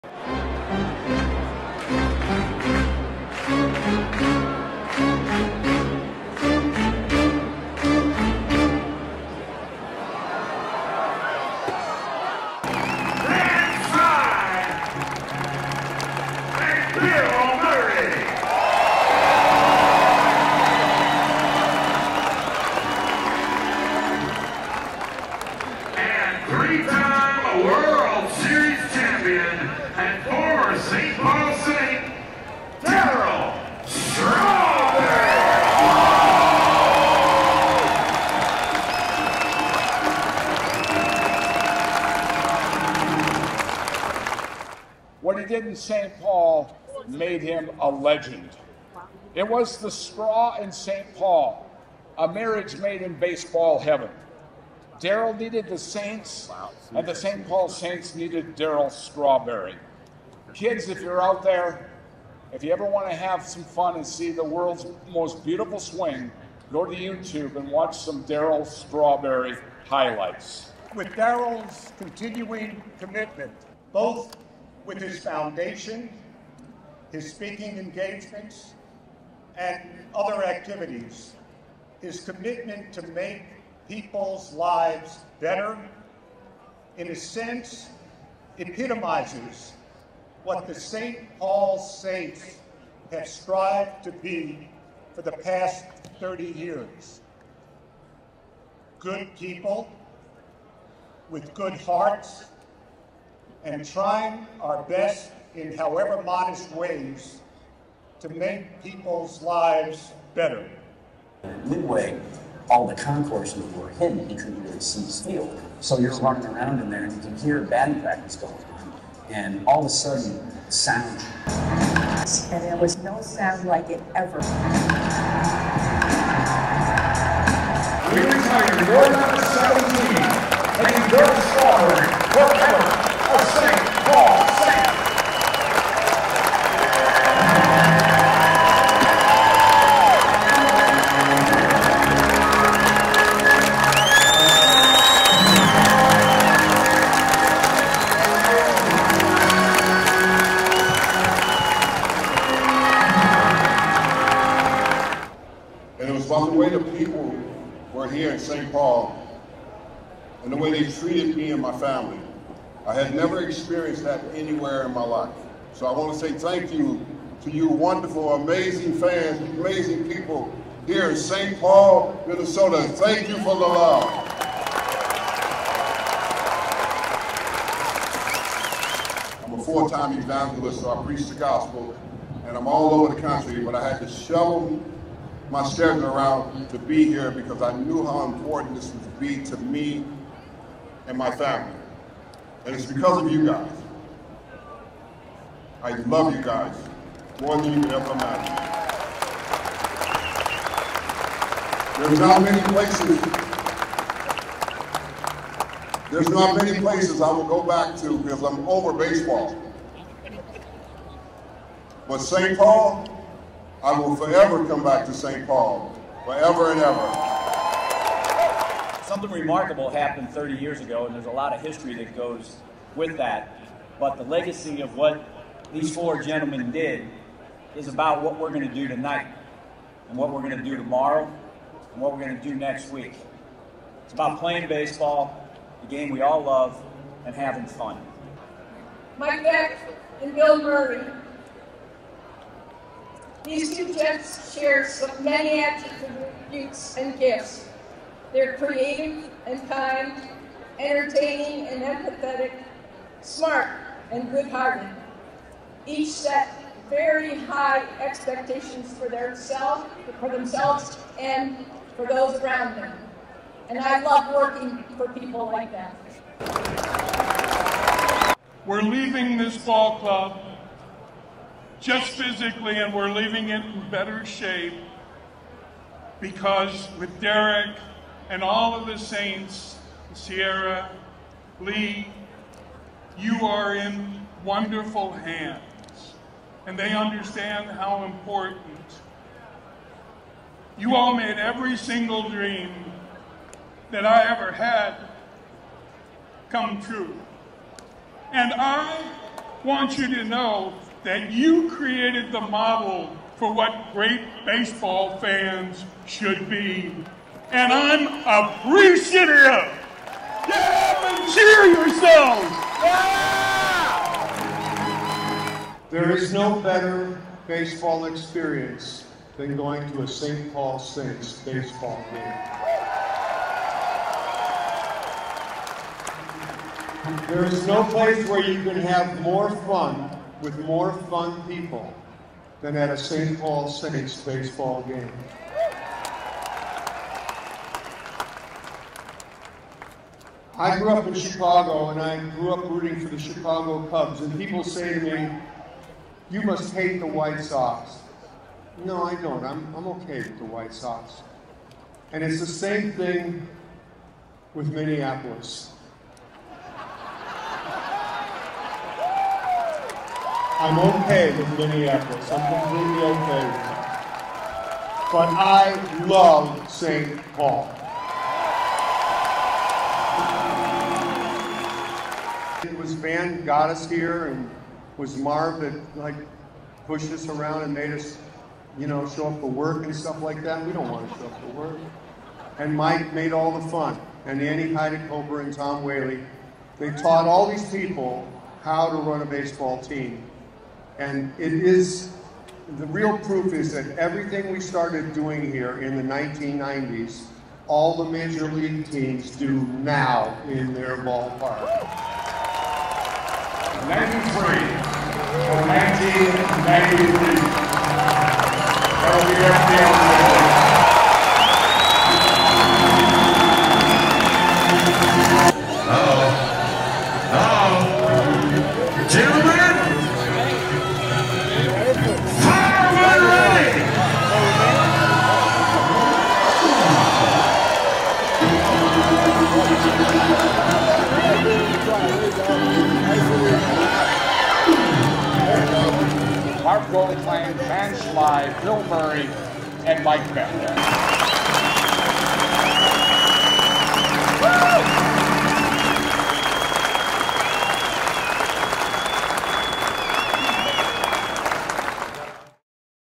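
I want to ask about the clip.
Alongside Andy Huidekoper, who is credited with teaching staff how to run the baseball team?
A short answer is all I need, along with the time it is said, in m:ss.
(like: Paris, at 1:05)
Tom Whaley, at 6:25.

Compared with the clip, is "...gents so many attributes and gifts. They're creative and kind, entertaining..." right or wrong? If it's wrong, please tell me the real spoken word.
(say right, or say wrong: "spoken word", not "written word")
right.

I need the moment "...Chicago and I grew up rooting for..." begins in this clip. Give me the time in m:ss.
5:41.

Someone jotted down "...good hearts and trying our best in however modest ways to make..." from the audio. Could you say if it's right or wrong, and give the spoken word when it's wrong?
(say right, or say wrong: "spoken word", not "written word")
right.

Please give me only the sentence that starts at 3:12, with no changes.
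And it's because of you guys.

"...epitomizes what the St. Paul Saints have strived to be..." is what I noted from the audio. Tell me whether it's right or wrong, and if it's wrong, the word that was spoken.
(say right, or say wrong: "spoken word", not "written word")
right.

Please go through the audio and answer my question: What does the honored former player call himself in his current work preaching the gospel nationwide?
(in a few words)
four-time evangelist.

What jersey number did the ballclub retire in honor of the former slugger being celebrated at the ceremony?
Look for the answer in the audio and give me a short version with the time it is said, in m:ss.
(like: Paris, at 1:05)
17, at 2:08.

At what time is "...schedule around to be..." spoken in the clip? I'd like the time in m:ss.
3:05.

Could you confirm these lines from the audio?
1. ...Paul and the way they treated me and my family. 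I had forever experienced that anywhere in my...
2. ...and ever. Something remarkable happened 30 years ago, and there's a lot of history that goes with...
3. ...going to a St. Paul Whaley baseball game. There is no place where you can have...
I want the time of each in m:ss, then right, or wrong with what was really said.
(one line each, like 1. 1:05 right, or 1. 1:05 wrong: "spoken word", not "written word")
1. 2:38 wrong: "never", not "forever"
2. 3:36 right
3. 5:19 wrong: "Saints", not "Whaley".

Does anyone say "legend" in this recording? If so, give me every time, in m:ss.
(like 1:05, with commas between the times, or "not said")
0:47.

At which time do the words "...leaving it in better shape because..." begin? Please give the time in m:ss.
4:33.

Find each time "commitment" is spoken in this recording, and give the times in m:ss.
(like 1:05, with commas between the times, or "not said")
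1:12, 1:22.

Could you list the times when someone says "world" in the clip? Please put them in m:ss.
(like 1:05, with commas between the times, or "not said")
1:04.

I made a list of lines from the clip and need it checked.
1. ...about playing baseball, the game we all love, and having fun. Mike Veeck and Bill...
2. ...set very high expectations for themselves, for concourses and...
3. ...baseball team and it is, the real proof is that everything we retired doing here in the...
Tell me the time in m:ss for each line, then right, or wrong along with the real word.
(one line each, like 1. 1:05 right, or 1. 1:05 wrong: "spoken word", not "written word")
1. 3:54 right
2. 4:16 wrong: "themselves", not "concourses"
3. 6:29 wrong: "started", not "retired".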